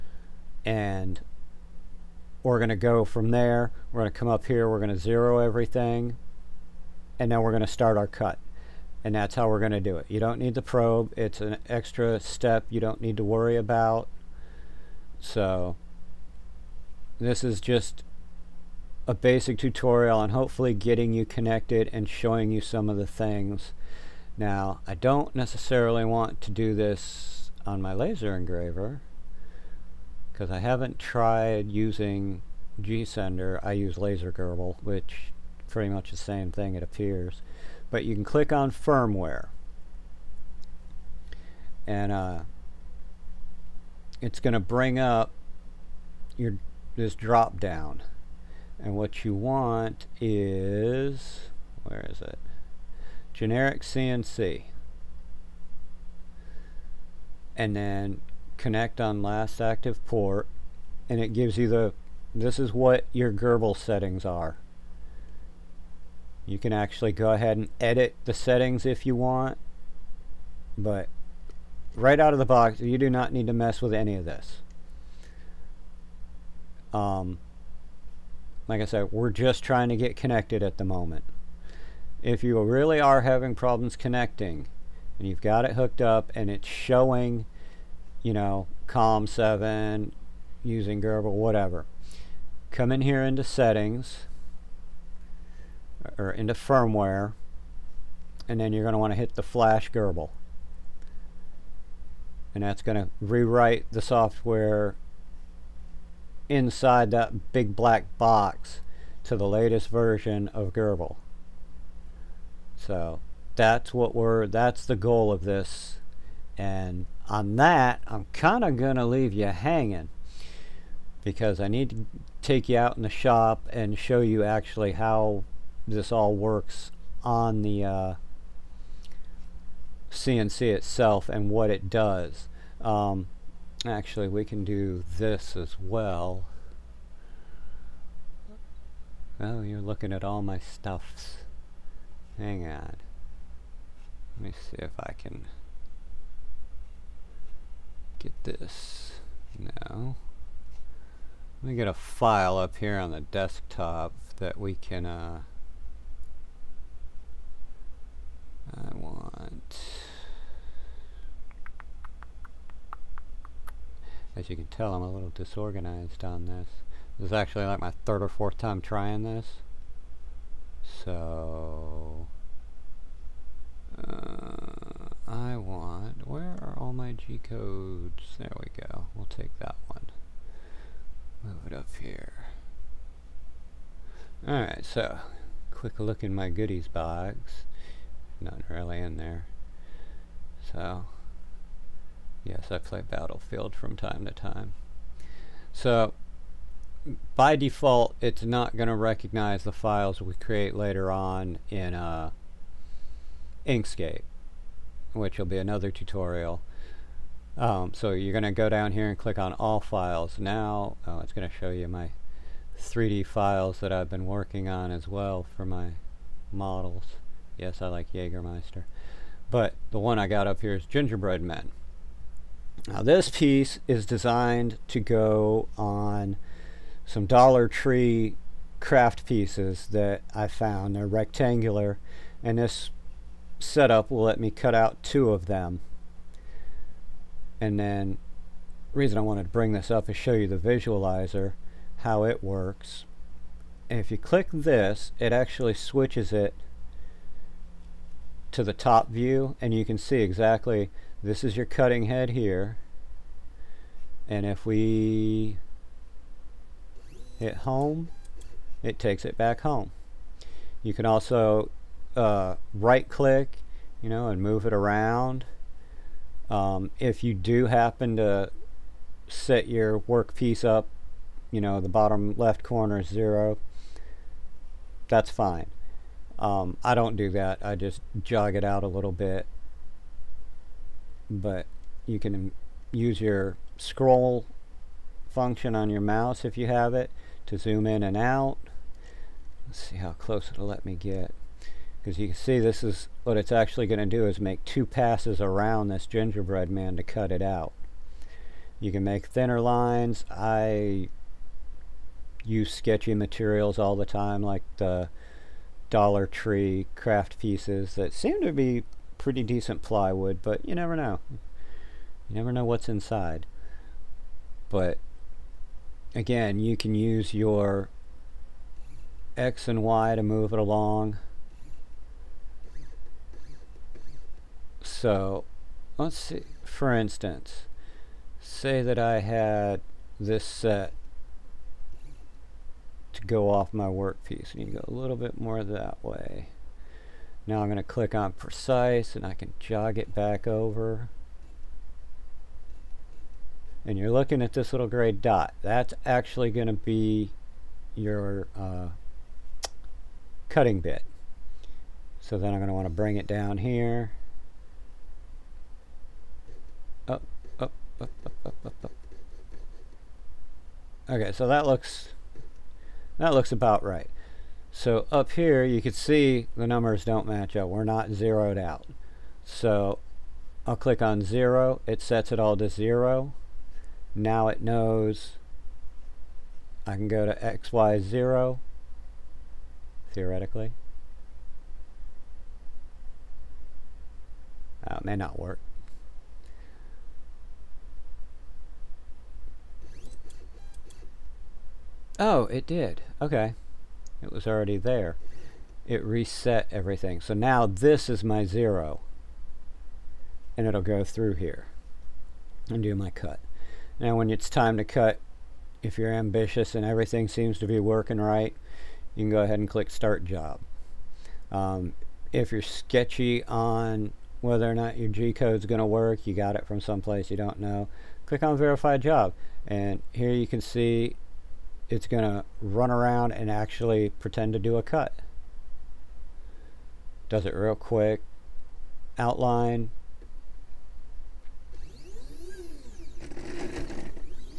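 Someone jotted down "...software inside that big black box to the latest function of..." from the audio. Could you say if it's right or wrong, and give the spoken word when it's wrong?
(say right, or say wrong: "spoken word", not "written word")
wrong: "version", not "function".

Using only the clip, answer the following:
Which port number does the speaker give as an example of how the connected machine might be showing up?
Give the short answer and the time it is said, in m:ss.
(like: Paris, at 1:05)
COM7, at 1:28.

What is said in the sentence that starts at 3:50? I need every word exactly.
They're rectangular and this setup will let me cut out two of them.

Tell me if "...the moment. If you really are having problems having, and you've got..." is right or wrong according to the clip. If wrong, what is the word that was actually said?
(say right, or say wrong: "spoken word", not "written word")
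wrong: "connecting", not "having".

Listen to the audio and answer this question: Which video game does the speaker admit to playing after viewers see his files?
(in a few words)
Battlefield.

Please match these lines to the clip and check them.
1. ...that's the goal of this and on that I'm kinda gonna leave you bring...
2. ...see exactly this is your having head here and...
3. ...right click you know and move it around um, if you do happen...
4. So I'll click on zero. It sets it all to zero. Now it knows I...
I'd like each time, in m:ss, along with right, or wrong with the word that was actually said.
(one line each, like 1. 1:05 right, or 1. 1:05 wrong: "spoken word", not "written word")
1. 1:54 wrong: "hanging", not "bring"
2. 4:09 wrong: "cutting", not "having"
3. 4:22 right
4. 6:09 right.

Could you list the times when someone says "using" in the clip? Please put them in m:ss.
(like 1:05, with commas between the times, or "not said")
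0:31, 1:30.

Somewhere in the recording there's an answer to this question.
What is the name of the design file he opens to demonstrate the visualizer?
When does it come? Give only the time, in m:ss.
3:40.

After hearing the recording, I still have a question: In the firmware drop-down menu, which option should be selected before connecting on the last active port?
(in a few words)
generic CNC.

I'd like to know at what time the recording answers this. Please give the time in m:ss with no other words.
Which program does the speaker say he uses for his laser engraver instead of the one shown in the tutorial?
0:33.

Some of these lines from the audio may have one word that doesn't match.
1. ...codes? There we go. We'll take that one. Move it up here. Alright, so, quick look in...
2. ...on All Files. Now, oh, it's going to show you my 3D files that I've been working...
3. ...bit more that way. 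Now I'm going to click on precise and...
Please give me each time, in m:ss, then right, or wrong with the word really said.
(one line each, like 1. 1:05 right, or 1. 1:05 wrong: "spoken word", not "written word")
1. 2:57 right
2. 3:29 right
3. 5:35 right.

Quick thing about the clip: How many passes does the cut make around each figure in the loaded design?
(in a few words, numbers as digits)
2.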